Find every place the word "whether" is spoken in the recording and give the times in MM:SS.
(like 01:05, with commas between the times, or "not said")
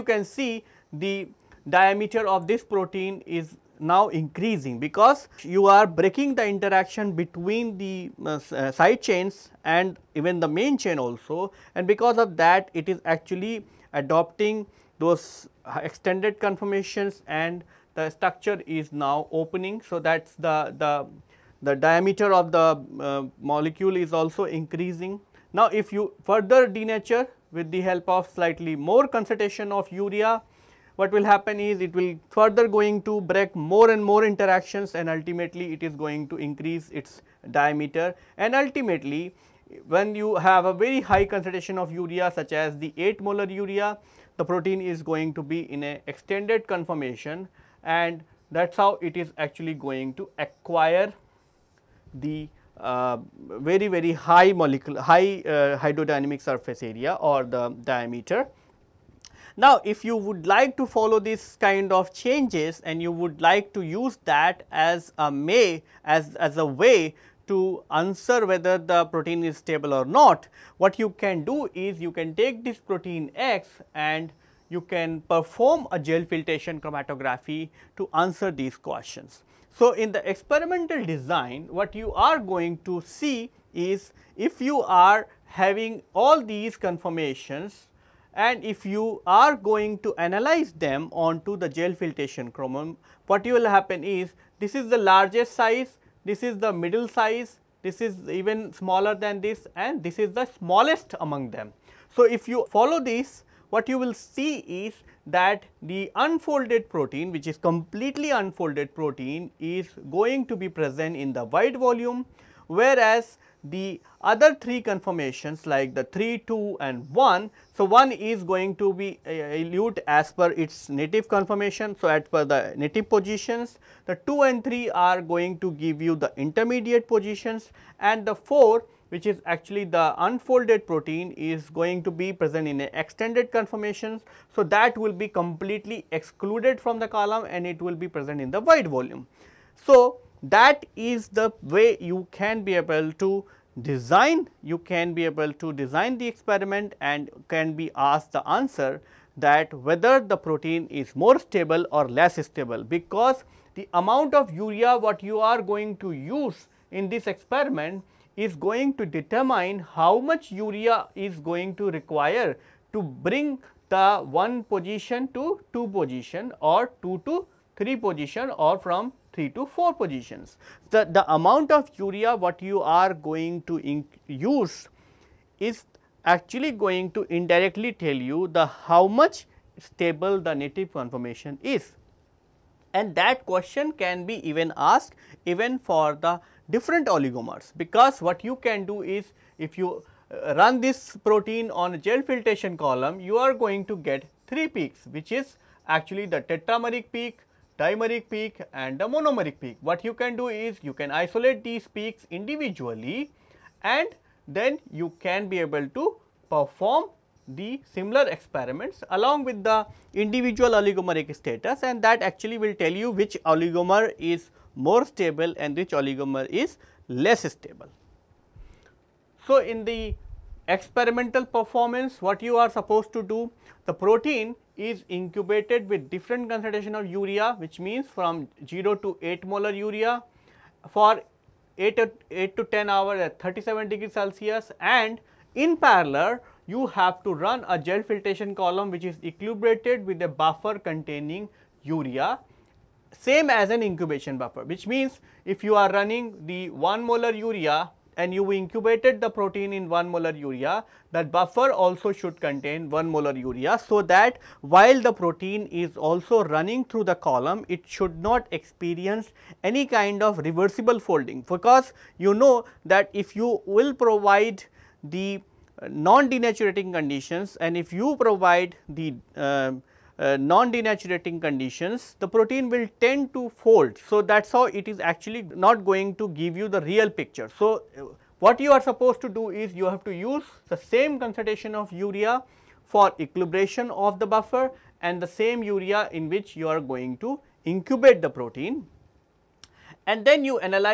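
01:08, 02:29.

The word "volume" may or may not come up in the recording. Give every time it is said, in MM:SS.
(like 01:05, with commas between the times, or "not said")
01:51, 02:18.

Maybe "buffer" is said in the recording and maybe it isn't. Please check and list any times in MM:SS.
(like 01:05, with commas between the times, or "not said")
04:00, 04:04, 04:11, 04:44.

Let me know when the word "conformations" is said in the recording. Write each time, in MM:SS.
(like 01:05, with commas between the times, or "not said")
00:16, 00:46, 01:26, 01:54, 02:01, 02:13, 03:00.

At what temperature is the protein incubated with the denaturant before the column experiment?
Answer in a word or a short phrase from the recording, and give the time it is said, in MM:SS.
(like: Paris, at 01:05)
37 degrees Celsius, at 03:53.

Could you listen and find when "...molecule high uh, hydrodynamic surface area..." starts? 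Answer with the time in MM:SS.
00:54.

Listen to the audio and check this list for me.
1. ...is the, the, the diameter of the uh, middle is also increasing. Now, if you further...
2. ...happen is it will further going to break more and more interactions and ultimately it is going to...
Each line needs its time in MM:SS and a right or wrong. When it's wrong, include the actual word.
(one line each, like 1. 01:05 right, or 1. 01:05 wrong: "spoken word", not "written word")
1. 00:20 wrong: "molecule", not "middle"
2. 00:31 right.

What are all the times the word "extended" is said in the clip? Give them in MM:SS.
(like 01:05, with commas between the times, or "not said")
00:15, 00:46, 02:12.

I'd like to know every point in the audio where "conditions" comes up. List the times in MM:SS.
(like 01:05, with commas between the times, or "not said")
04:26, 04:31.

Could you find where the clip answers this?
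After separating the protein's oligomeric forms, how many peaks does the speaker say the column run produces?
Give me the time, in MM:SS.
03:14.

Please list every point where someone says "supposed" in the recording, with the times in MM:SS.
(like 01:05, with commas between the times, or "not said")
03:42, 04:38.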